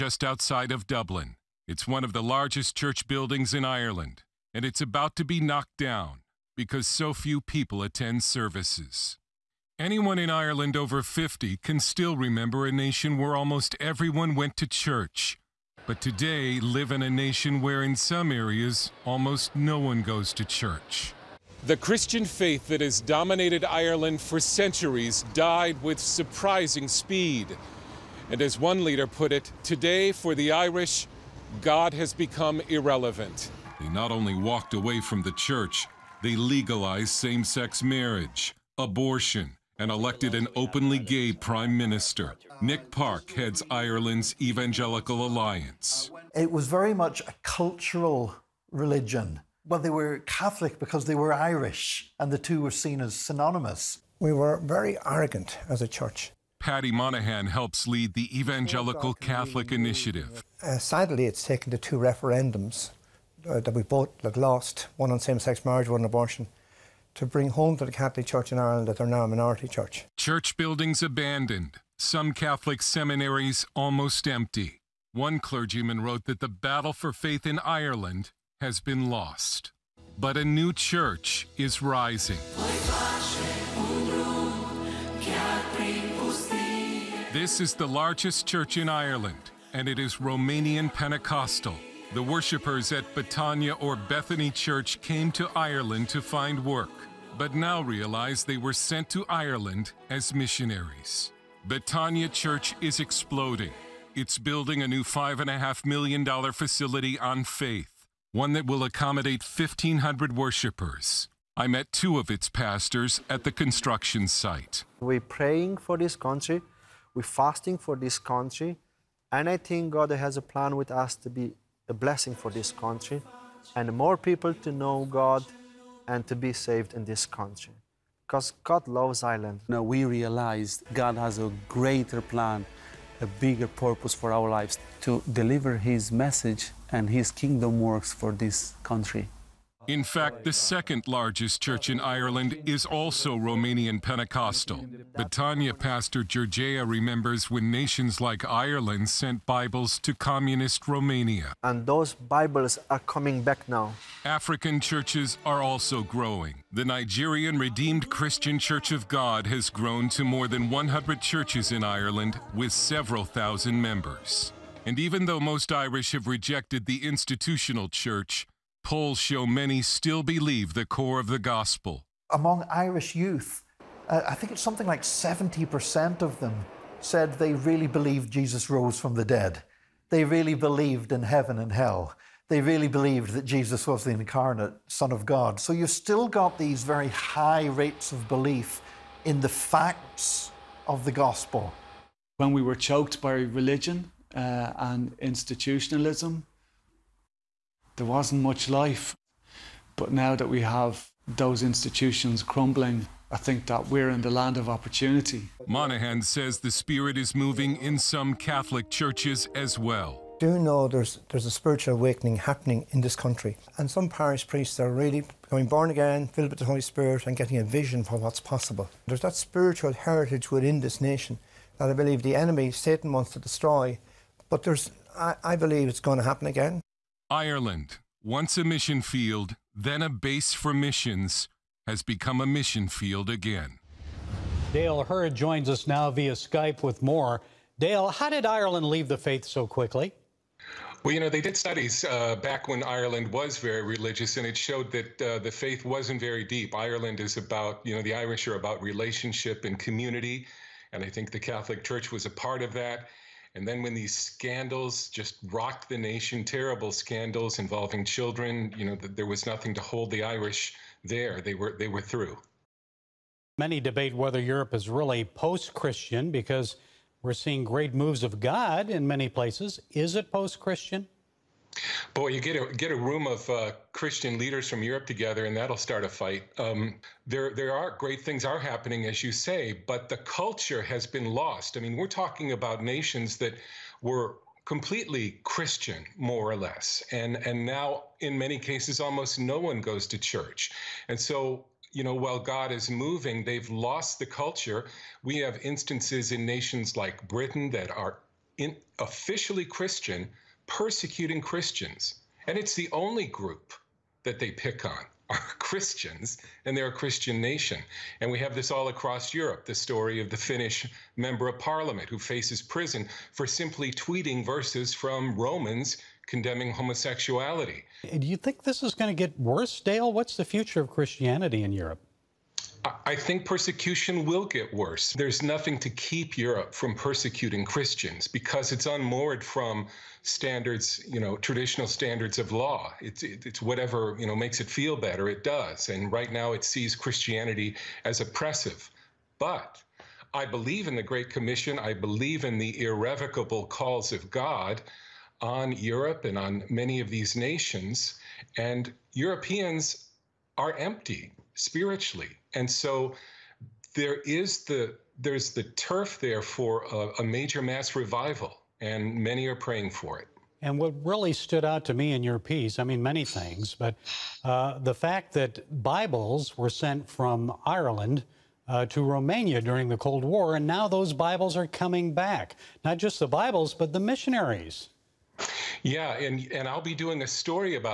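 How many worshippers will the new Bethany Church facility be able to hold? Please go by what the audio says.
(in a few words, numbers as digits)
1,500.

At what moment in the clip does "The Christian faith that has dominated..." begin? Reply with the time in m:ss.
0:21.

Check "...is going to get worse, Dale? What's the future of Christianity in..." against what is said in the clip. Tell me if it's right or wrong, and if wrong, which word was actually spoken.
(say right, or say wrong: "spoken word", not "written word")
right.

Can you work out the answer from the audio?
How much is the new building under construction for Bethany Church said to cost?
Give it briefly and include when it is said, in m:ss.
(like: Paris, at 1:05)
$5.5 million, at 1:45.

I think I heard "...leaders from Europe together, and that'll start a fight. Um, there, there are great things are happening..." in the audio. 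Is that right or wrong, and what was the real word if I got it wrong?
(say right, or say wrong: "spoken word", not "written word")
right.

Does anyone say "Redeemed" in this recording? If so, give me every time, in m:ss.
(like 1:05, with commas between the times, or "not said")
2:37.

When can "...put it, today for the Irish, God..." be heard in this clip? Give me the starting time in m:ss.
0:29.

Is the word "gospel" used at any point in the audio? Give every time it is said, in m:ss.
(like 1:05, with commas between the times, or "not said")
2:51, 3:11.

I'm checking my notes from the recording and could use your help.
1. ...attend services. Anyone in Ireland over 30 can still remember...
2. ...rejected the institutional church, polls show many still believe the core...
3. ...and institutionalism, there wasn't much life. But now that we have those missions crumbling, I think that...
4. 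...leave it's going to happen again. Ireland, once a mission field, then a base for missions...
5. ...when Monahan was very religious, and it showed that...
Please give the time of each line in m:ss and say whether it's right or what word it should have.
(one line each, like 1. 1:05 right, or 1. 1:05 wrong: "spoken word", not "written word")
1. 0:07 wrong: "50", not "30"
2. 2:46 right
3. 3:14 wrong: "institutions", not "missions"
4. 3:45 wrong: "believe", not "leave"
5. 4:02 wrong: "Ireland", not "Monahan".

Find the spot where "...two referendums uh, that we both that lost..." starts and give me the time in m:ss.
1:01.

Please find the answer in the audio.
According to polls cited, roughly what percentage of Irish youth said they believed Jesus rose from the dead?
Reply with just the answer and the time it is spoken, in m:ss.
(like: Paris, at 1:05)
70%, at 2:55.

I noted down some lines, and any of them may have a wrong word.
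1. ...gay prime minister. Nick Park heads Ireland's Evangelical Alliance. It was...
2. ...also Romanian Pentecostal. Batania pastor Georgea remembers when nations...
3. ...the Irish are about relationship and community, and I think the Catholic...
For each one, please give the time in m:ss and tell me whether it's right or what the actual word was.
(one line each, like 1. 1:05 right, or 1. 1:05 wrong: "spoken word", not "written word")
1. 0:40 right
2. 2:22 right
3. 4:08 right.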